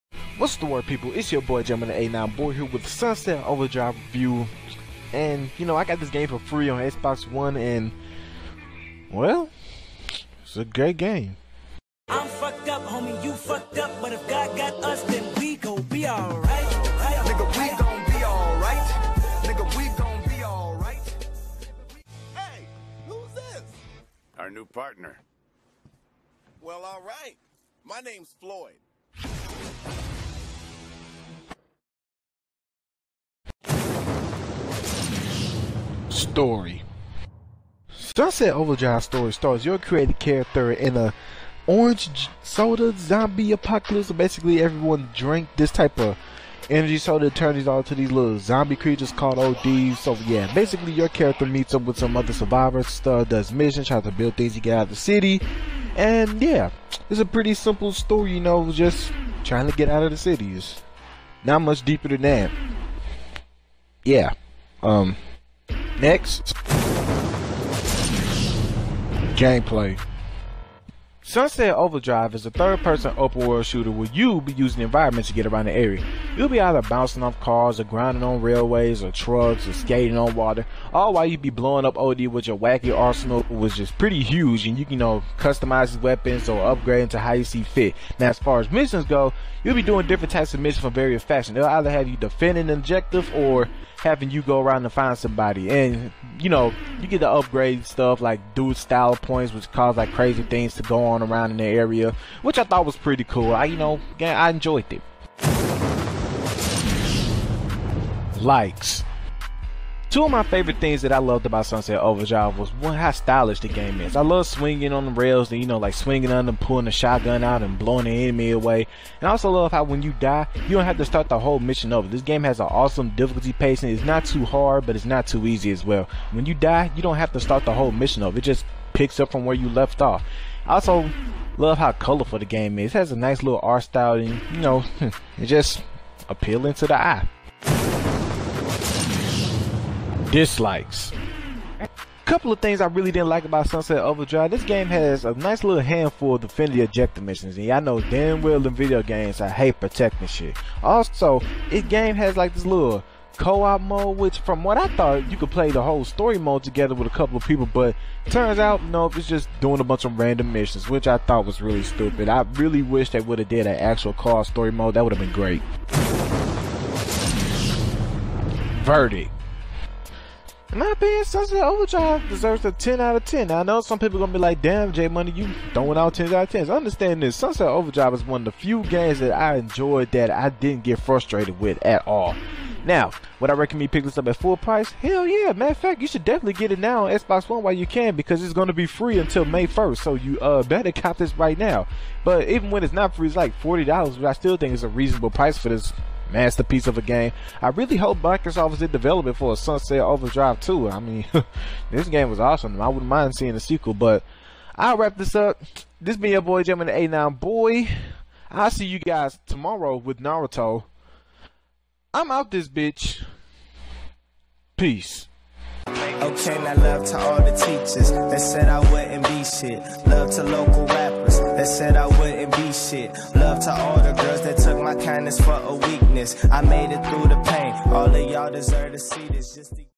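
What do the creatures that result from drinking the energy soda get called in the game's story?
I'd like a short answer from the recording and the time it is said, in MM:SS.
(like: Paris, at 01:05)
ODs, at 00:49.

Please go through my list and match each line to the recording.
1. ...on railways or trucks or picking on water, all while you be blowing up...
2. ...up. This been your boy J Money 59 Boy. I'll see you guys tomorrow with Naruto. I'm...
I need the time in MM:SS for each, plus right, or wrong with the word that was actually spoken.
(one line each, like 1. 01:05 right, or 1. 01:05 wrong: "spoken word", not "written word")
1. 01:18 wrong: "skating", not "picking"
2. 03:25 wrong: "89", not "59".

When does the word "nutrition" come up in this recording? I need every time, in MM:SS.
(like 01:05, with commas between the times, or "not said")
not said.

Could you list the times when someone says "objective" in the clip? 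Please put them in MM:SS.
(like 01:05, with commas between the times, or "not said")
01:32, 02:26.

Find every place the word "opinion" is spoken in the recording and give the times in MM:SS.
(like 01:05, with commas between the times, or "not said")
02:50.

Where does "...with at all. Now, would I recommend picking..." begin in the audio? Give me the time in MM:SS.
03:01.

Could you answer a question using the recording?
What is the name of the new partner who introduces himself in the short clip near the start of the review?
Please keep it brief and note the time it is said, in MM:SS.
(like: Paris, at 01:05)
Floyd, at 00:28.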